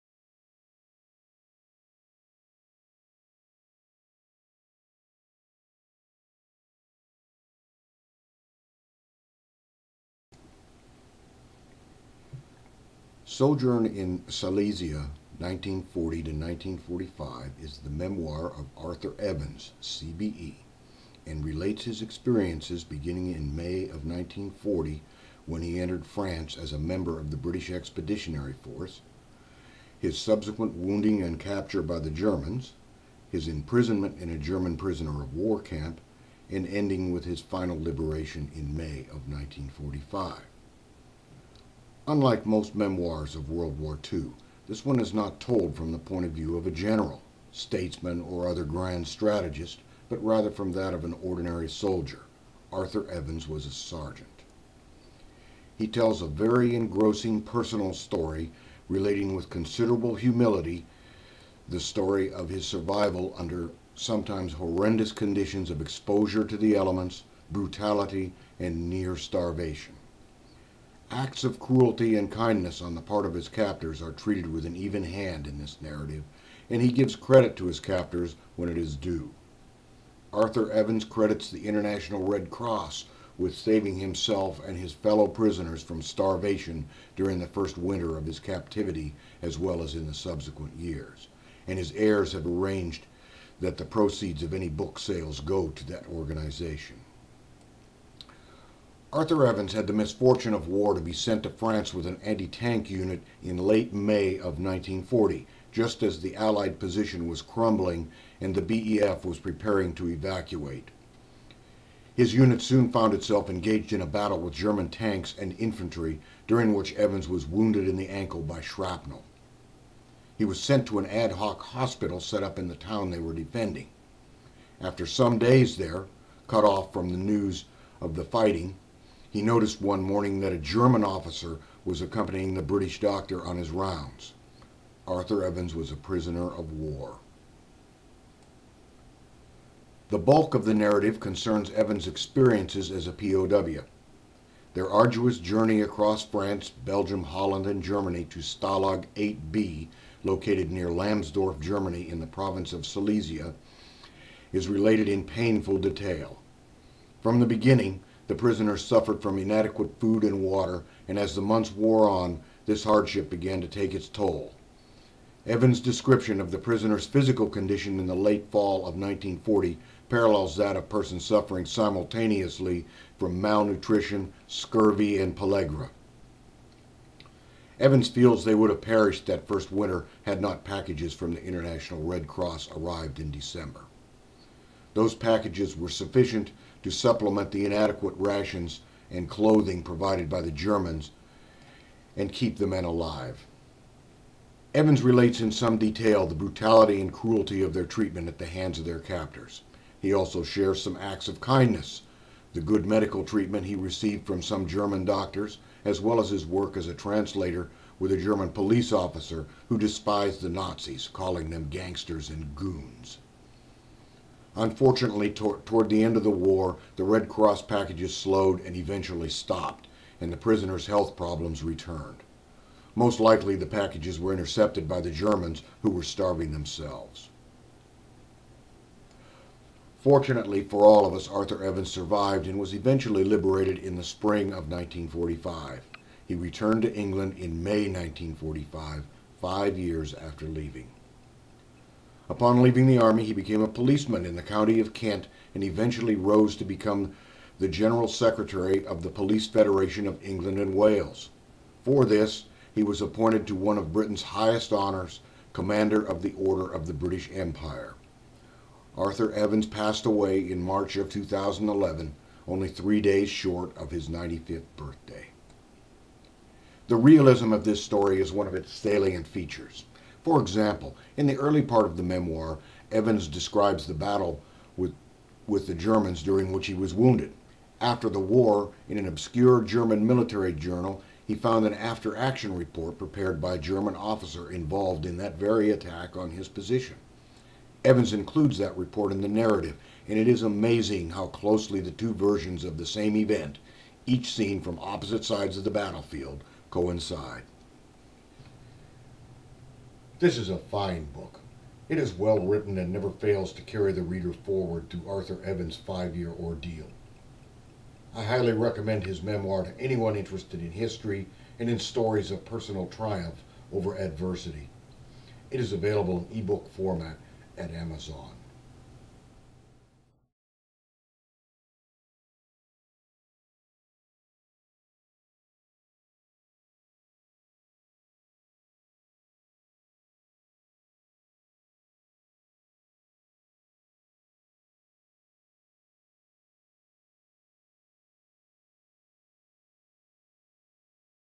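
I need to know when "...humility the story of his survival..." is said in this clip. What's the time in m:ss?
1:00.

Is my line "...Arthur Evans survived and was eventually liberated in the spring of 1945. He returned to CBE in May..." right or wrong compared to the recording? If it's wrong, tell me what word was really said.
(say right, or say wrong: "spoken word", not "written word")
wrong: "England", not "CBE".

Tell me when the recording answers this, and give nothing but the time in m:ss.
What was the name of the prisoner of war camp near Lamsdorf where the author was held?
2:28.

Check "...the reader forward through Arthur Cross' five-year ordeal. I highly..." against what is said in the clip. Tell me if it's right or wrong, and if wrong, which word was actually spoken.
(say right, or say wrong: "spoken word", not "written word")
wrong: "Evans", not "Cross".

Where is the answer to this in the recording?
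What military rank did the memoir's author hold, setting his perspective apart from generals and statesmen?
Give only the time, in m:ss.
0:53.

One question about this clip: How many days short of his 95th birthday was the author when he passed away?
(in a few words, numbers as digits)
3.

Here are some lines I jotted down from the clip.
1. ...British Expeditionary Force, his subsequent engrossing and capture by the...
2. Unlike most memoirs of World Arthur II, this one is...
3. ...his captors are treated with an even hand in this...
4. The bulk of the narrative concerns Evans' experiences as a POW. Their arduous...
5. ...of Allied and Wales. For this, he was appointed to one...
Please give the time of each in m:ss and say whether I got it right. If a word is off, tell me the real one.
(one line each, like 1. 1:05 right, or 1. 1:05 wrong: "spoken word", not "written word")
1. 0:27 wrong: "wounding", not "engrossing"
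2. 0:42 wrong: "War", not "Arthur"
3. 1:13 right
4. 2:20 right
5. 4:10 wrong: "England", not "Allied".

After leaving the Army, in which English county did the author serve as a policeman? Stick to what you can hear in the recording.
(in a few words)
Kent.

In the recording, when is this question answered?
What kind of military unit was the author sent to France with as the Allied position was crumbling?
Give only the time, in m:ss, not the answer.
1:42.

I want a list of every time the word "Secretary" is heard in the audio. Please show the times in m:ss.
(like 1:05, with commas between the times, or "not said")
4:08.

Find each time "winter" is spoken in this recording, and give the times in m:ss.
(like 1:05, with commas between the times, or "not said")
1:27, 2:59.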